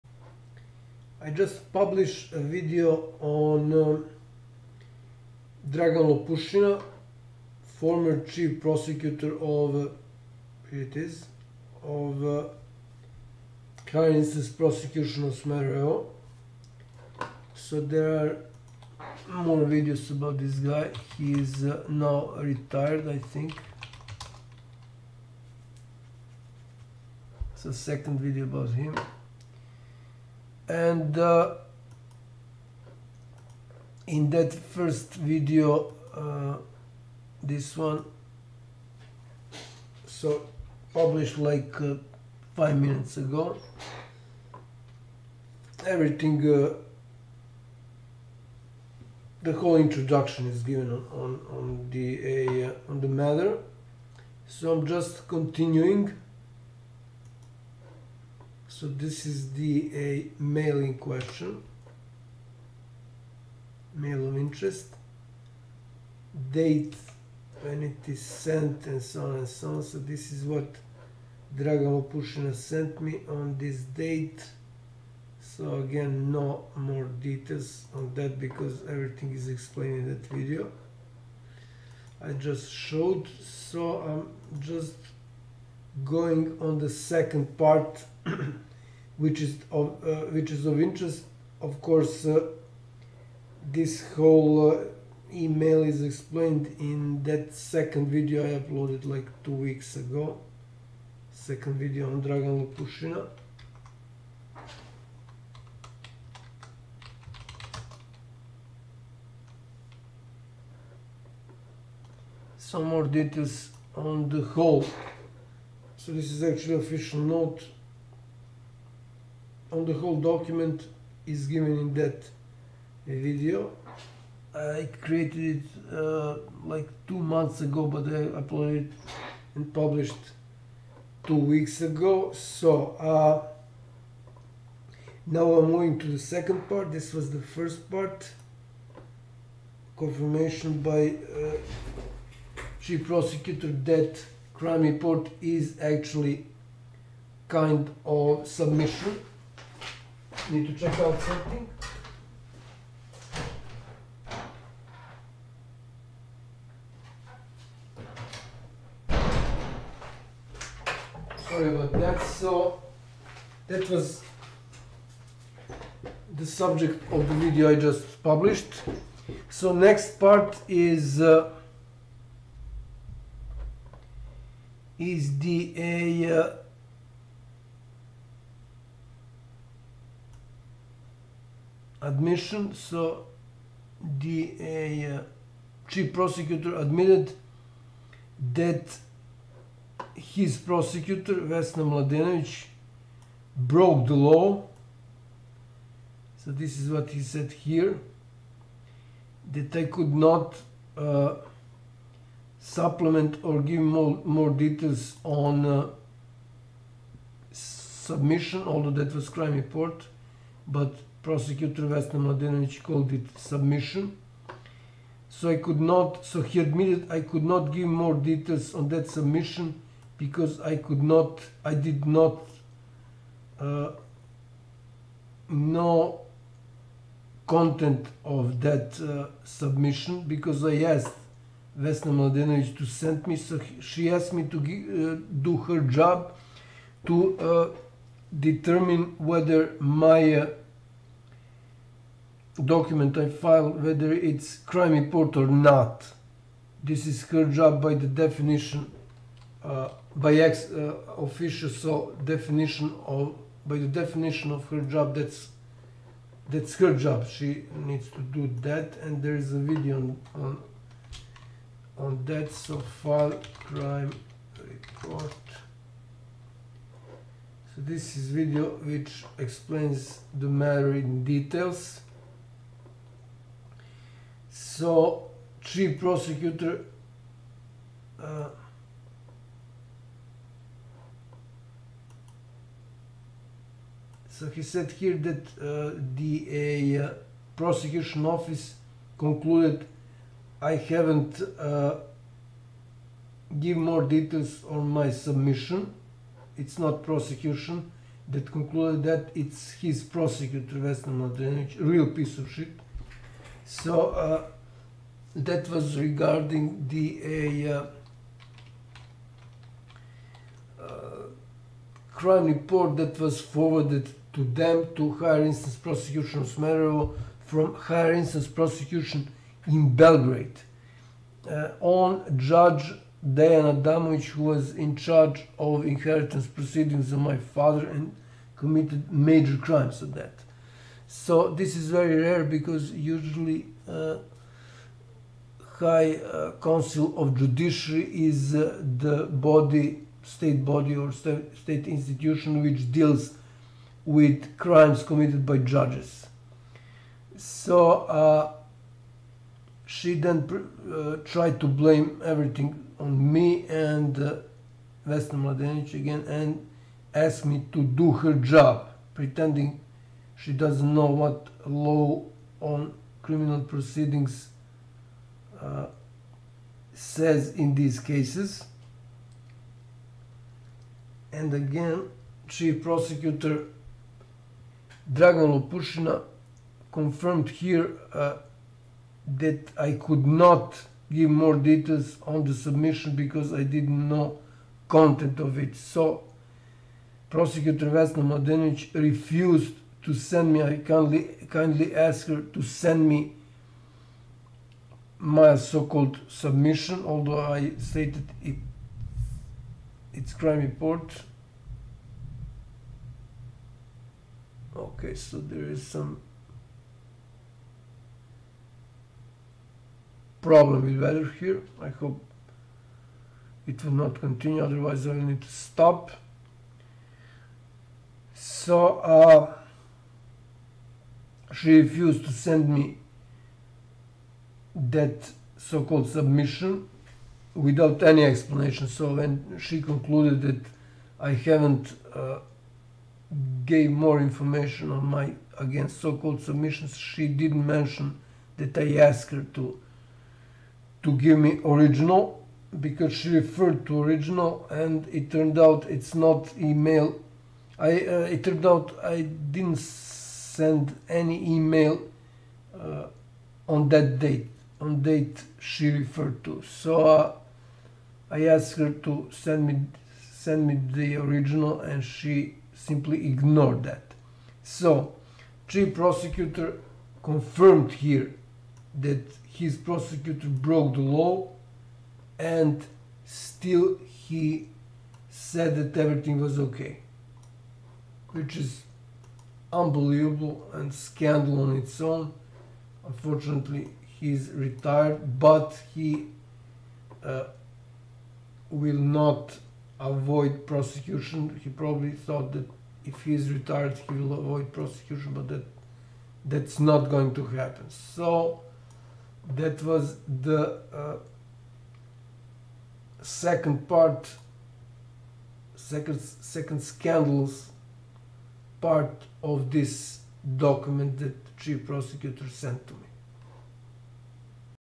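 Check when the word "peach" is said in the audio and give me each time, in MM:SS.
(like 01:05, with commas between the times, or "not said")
not said.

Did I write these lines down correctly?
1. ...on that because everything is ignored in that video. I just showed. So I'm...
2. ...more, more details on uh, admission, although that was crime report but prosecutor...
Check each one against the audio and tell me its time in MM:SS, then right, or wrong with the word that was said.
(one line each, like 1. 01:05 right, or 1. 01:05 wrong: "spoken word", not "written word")
1. 01:17 wrong: "explained", not "ignored"
2. 03:23 wrong: "submission", not "admission".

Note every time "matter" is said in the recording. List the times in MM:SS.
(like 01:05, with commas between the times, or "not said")
00:53, 04:30.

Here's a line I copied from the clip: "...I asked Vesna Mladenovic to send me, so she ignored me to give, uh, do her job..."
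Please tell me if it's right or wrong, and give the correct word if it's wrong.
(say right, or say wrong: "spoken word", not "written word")
wrong: "asked", not "ignored".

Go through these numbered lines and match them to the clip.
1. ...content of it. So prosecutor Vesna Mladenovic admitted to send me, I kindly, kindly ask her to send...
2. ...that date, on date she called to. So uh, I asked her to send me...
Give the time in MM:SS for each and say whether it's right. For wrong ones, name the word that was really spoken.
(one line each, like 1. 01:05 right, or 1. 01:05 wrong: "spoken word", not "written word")
1. 06:24 wrong: "refused", not "admitted"
2. 07:33 wrong: "referred", not "called".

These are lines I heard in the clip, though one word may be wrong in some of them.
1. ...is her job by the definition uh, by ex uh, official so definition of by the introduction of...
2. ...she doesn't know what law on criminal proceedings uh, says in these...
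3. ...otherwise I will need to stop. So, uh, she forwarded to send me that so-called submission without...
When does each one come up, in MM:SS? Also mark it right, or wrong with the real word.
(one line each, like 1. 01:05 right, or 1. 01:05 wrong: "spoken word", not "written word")
1. 04:07 wrong: "definition", not "introduction"
2. 06:00 right
3. 06:54 wrong: "refused", not "forwarded".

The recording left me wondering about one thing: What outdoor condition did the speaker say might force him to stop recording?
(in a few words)
weather.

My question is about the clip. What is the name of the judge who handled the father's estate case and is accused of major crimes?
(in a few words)
Diana Damovic.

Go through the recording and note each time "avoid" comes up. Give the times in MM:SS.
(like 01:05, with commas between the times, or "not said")
08:09, 08:14.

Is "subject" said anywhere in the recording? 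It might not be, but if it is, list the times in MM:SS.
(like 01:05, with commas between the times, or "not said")
02:46.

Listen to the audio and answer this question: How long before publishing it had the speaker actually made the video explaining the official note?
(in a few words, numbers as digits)
2 months ago.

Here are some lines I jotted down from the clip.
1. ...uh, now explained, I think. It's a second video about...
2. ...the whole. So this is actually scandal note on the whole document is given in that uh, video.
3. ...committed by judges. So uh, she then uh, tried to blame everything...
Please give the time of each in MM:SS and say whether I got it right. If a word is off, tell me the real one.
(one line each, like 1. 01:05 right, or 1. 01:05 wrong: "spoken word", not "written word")
1. 00:21 wrong: "retired", not "explained"
2. 01:54 wrong: "official", not "scandal"
3. 05:45 right.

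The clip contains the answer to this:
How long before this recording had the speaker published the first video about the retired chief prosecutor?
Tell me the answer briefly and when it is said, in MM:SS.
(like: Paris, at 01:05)
5 minutes ago, at 00:42.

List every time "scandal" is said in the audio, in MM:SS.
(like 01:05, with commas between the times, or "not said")
08:00, 08:26.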